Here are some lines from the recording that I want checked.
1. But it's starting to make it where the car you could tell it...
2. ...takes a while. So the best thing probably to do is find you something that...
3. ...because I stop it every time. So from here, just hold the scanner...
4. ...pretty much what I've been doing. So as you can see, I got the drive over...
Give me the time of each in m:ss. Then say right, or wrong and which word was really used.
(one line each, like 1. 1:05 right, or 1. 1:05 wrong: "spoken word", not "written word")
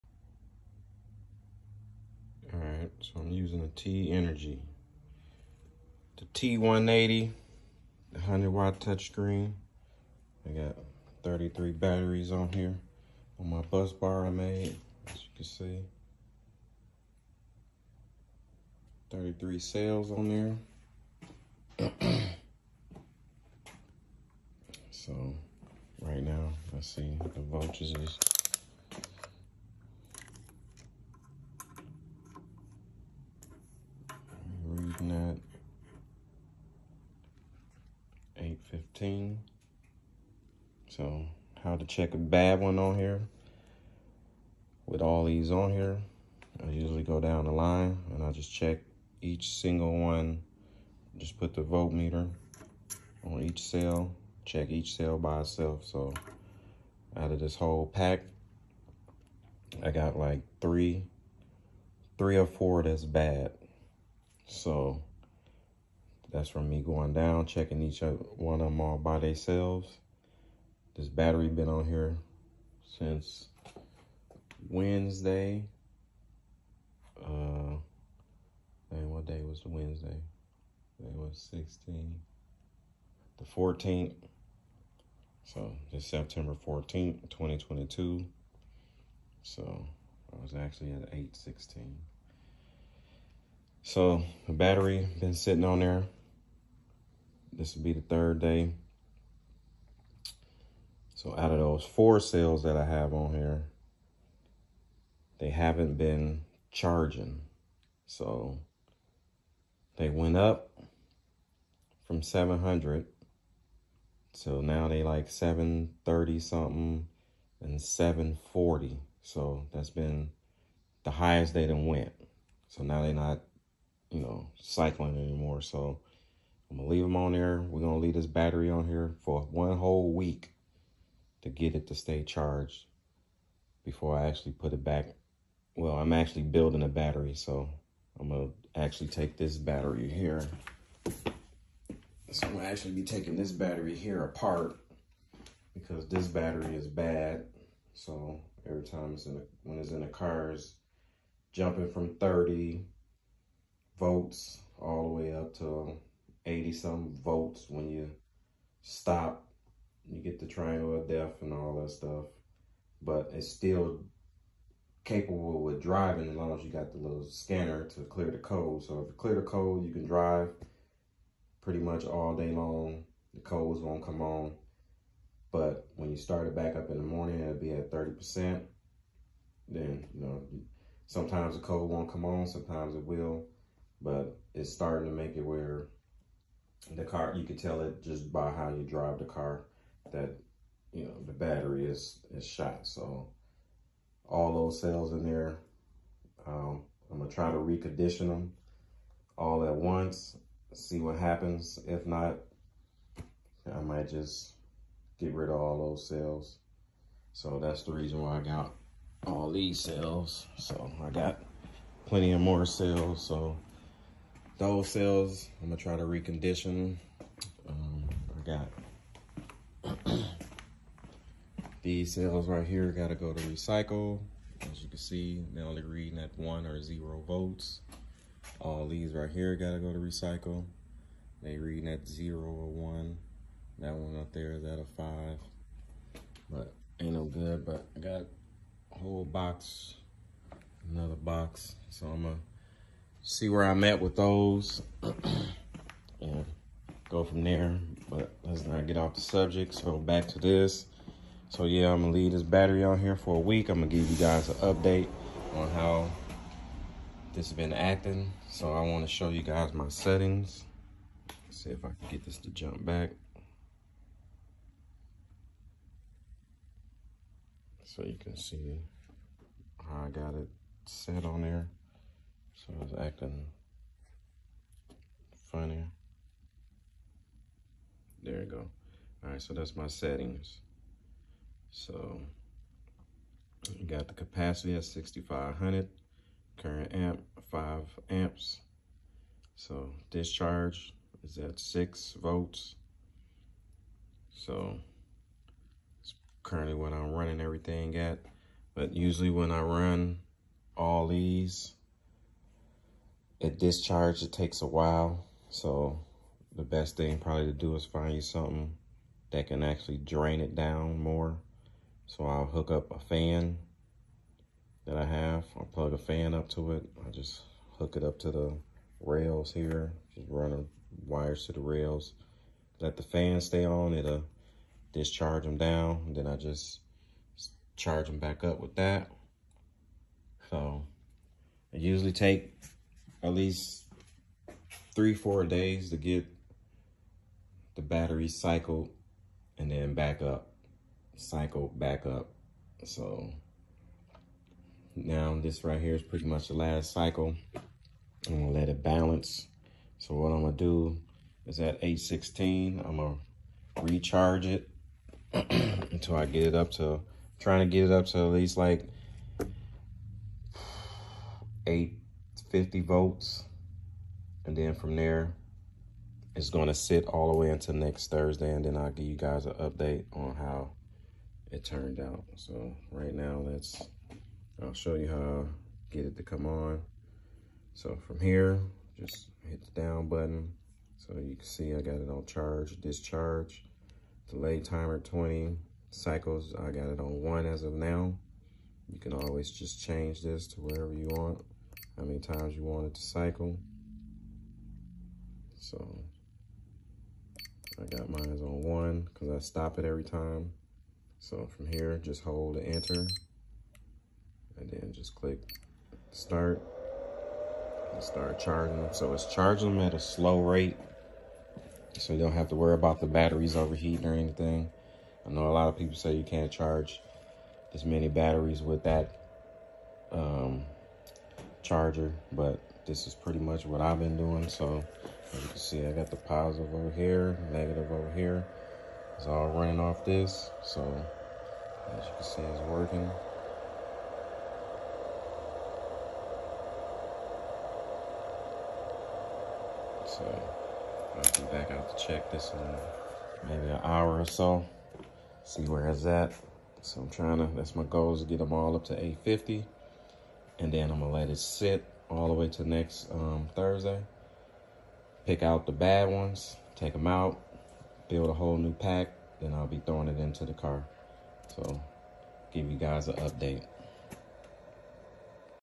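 1. 3:04 right
2. 5:04 right
3. 6:39 wrong: "enter", not "scanner"
4. 7:03 wrong: "positive", not "drive".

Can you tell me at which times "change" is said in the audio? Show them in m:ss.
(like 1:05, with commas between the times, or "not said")
6:29.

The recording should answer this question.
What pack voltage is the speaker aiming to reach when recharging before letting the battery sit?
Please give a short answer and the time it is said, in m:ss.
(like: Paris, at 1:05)
850, at 6:01.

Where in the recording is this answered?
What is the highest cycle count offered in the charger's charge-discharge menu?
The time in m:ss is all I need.
6:24.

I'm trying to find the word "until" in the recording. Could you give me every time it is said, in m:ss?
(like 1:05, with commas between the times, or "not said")
5:55, 6:07.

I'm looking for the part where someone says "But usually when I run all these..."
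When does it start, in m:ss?
4:58.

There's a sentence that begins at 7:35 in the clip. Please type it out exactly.
Pick out the bad ones, take them out, build a whole new pack, then I'll be throwing it into the car.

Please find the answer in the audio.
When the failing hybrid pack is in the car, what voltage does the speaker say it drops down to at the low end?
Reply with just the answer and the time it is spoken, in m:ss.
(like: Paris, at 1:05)
30 volts, at 2:32.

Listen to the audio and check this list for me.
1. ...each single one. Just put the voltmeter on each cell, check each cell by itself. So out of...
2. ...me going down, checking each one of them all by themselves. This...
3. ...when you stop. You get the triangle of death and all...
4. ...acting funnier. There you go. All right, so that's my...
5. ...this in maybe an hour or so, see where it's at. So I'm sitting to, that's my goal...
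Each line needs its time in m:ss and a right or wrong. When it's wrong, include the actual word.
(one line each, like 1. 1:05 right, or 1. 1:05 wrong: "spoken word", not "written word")
1. 0:49 right
2. 1:06 right
3. 2:37 right
4. 4:32 right
5. 7:22 wrong: "trying", not "sitting".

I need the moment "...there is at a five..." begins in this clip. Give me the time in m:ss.
3:54.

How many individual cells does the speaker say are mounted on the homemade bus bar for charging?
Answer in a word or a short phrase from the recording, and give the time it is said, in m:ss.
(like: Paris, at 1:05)
33, at 0:19.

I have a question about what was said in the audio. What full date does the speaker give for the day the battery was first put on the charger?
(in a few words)
September 14th, 2022.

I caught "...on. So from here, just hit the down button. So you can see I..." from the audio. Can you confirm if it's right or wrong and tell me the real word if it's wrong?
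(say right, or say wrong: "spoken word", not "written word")
right.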